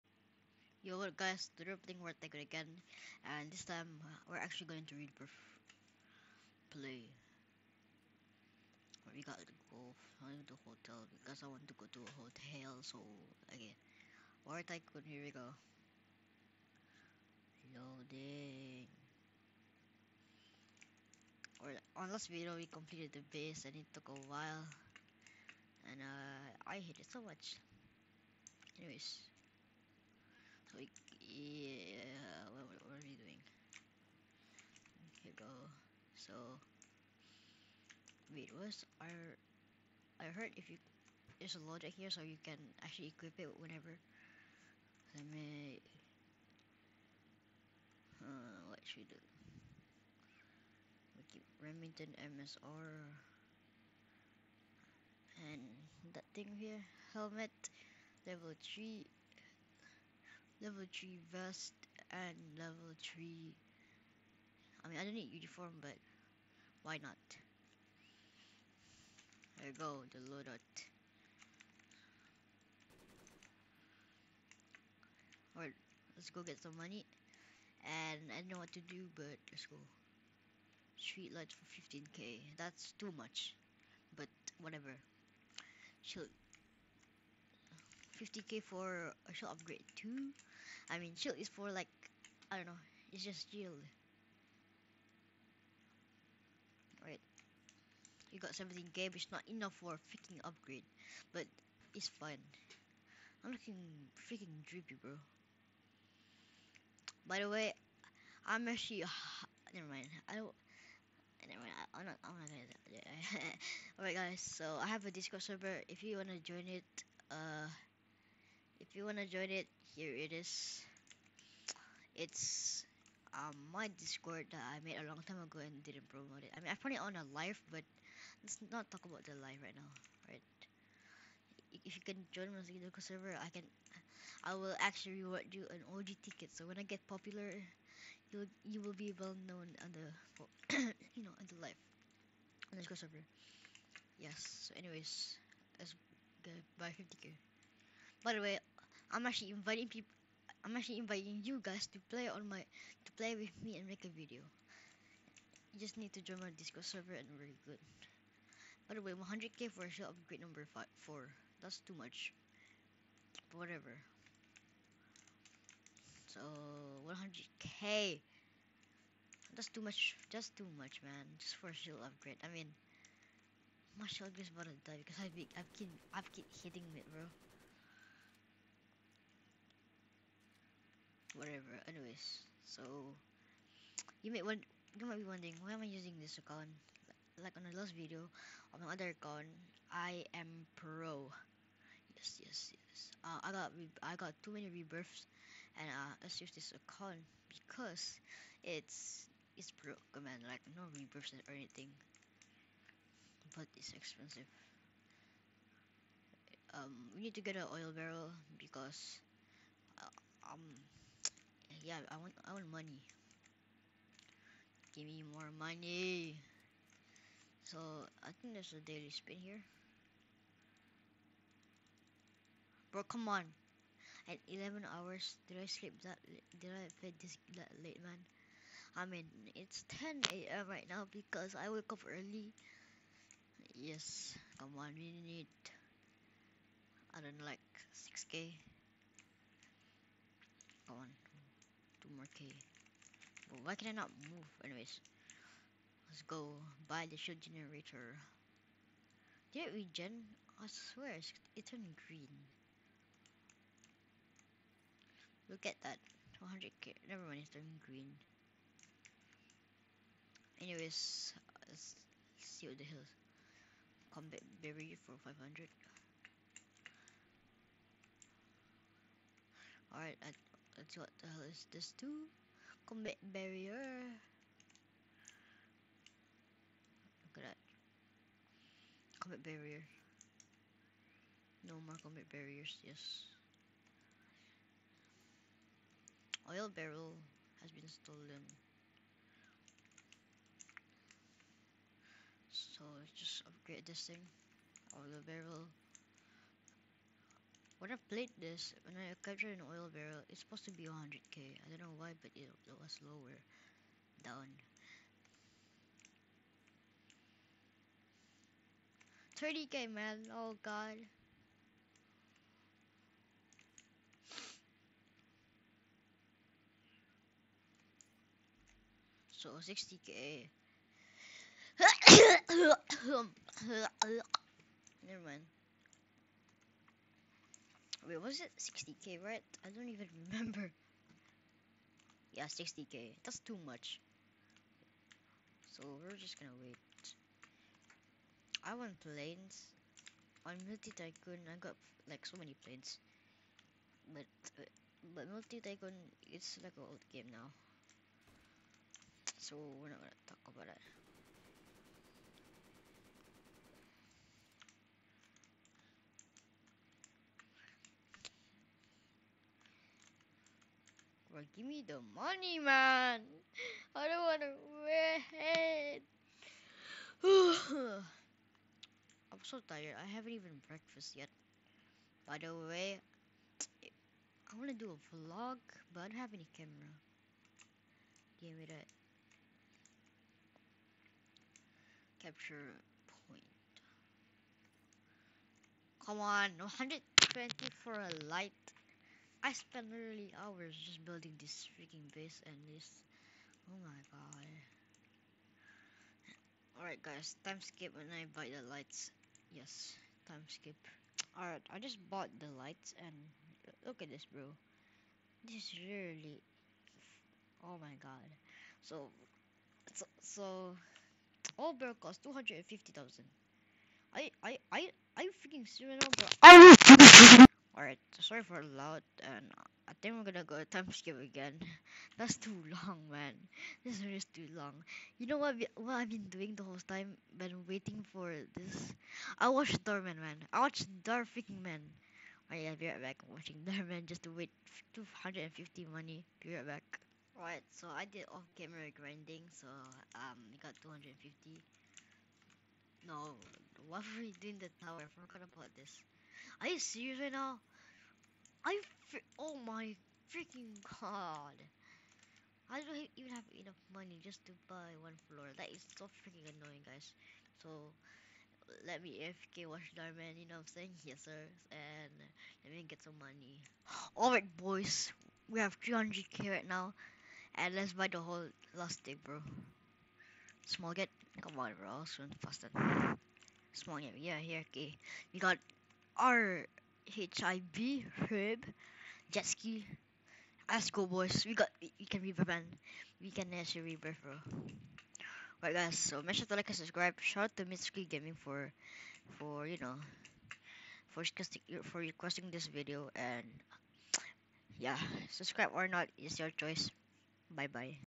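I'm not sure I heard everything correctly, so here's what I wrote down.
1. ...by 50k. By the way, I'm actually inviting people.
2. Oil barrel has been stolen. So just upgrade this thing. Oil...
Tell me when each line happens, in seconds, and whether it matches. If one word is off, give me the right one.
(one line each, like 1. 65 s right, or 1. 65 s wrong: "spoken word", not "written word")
1. 146 s right
2. 286 s right.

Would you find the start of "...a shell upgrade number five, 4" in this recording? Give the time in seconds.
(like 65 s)
159 s.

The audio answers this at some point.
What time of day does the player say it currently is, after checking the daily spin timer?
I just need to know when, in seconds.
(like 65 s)
230 s.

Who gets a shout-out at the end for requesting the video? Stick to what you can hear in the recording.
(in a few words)
Mitsuki Gaming.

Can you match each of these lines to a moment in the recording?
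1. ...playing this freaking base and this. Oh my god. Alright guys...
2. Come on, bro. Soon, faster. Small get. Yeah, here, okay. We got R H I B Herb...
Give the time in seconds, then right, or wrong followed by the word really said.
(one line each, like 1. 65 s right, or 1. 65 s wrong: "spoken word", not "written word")
1. 391 s wrong: "building", not "playing"
2. 471 s right.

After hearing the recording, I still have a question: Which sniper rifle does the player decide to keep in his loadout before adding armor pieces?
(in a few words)
Remington MSR.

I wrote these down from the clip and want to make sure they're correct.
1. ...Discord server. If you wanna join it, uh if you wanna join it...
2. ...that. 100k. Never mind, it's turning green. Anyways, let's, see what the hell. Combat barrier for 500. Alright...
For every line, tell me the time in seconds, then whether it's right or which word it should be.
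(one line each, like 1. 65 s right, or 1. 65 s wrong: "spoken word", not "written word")
1. 115 s right
2. 255 s right.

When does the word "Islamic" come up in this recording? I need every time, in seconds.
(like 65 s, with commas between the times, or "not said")
not said.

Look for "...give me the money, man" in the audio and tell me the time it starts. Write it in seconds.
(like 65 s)
361 s.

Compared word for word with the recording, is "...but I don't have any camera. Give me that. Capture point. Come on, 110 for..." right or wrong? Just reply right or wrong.
wrong.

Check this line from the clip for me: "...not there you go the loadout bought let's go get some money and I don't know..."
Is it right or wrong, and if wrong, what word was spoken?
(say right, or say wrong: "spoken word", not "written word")
wrong: "alright", not "bought".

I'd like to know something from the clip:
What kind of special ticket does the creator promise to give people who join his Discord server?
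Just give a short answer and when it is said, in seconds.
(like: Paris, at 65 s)
OG ticket, at 135 s.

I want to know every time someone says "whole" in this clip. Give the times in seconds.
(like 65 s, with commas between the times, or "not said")
426 s, 468 s.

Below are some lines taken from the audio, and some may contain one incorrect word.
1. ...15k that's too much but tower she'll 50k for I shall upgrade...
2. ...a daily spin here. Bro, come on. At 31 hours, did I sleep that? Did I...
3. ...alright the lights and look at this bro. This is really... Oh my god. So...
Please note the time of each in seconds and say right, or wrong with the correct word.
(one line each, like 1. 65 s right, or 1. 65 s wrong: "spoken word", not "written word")
1. 81 s wrong: "whatever", not "tower"
2. 218 s wrong: "11", not "31"
3. 402 s wrong: "bought", not "alright".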